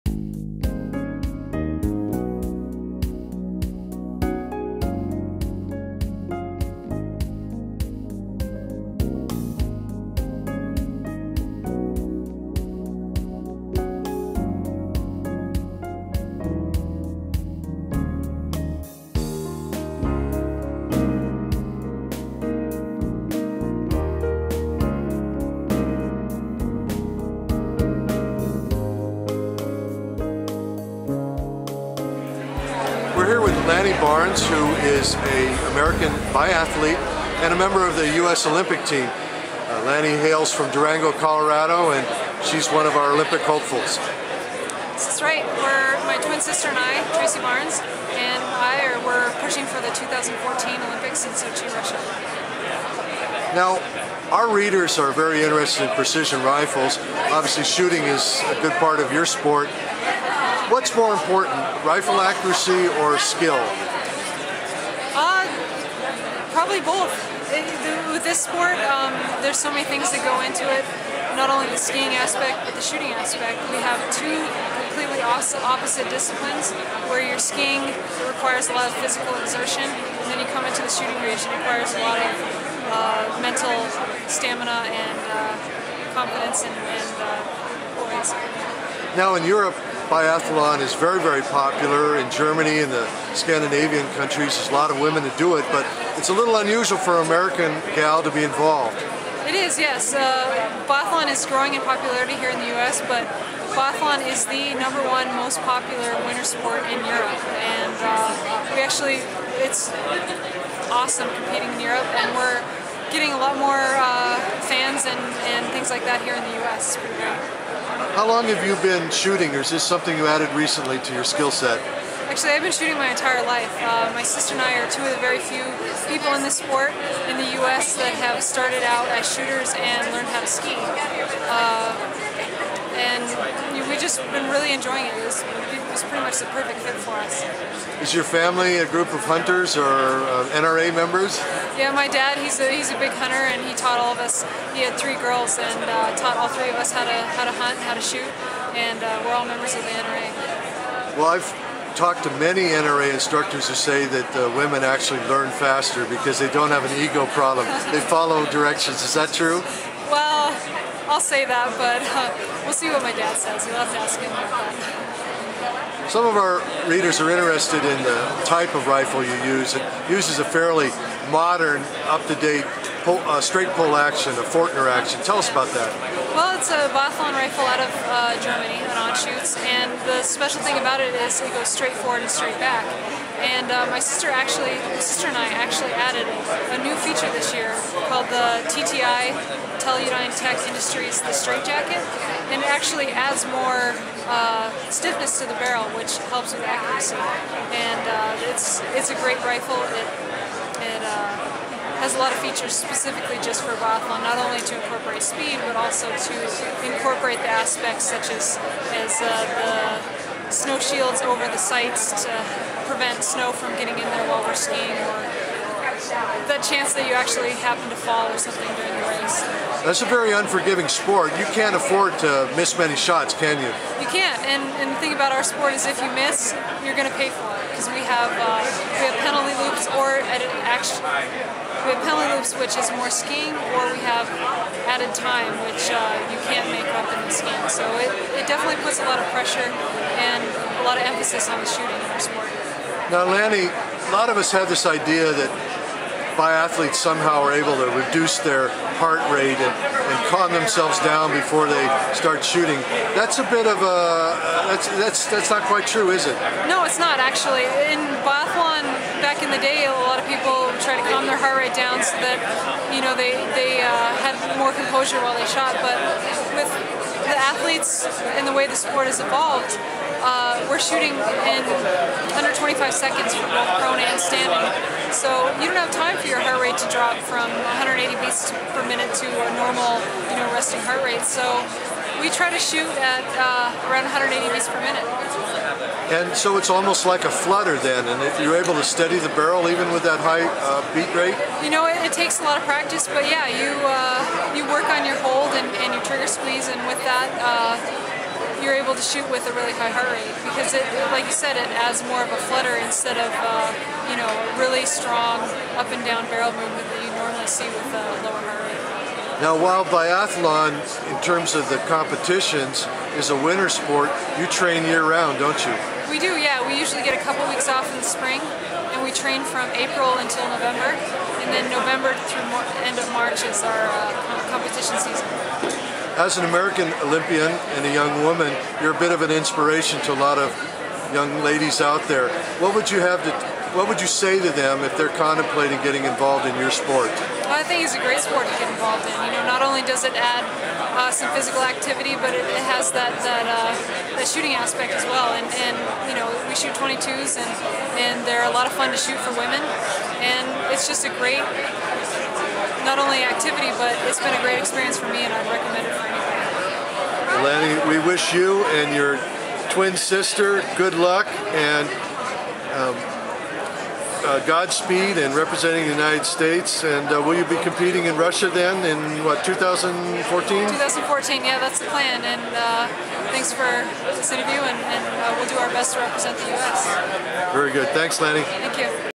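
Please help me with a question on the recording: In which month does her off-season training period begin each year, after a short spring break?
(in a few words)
April.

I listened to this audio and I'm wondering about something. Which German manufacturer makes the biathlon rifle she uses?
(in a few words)
Anschutz.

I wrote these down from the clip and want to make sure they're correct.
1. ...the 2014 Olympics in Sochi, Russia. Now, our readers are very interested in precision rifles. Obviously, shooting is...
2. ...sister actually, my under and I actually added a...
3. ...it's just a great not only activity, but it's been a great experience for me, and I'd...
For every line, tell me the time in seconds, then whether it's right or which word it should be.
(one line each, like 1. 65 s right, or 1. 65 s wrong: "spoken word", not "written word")
1. 49 s right
2. 183 s wrong: "sister", not "under"
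3. 350 s right.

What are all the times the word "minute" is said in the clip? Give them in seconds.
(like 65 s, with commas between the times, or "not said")
278 s, 284 s.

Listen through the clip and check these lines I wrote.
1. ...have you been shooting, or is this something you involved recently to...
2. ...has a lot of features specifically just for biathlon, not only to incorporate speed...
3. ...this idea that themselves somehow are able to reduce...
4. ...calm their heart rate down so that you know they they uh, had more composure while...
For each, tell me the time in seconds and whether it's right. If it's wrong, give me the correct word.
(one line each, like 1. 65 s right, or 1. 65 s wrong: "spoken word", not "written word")
1. 118 s wrong: "added", not "involved"
2. 202 s right
3. 244 s wrong: "biathletes", not "themselves"
4. 261 s right.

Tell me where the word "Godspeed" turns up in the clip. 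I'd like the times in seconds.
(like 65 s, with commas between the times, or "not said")
364 s.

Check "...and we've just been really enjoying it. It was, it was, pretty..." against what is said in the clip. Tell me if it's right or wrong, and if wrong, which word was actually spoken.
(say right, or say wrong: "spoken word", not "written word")
right.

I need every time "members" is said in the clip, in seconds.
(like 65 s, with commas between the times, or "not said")
37 s, 140 s, 149 s.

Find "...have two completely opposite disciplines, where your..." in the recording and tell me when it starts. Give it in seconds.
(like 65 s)
73 s.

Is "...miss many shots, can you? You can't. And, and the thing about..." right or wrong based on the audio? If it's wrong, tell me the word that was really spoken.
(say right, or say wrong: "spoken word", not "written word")
right.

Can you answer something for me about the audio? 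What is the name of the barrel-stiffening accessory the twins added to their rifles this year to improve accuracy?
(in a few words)
the Straight Jacket.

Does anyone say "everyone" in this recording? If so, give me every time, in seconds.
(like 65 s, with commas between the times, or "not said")
not said.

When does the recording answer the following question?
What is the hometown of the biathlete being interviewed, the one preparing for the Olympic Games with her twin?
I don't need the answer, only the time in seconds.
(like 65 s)
40 s.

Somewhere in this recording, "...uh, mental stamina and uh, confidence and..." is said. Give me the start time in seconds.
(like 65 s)
82 s.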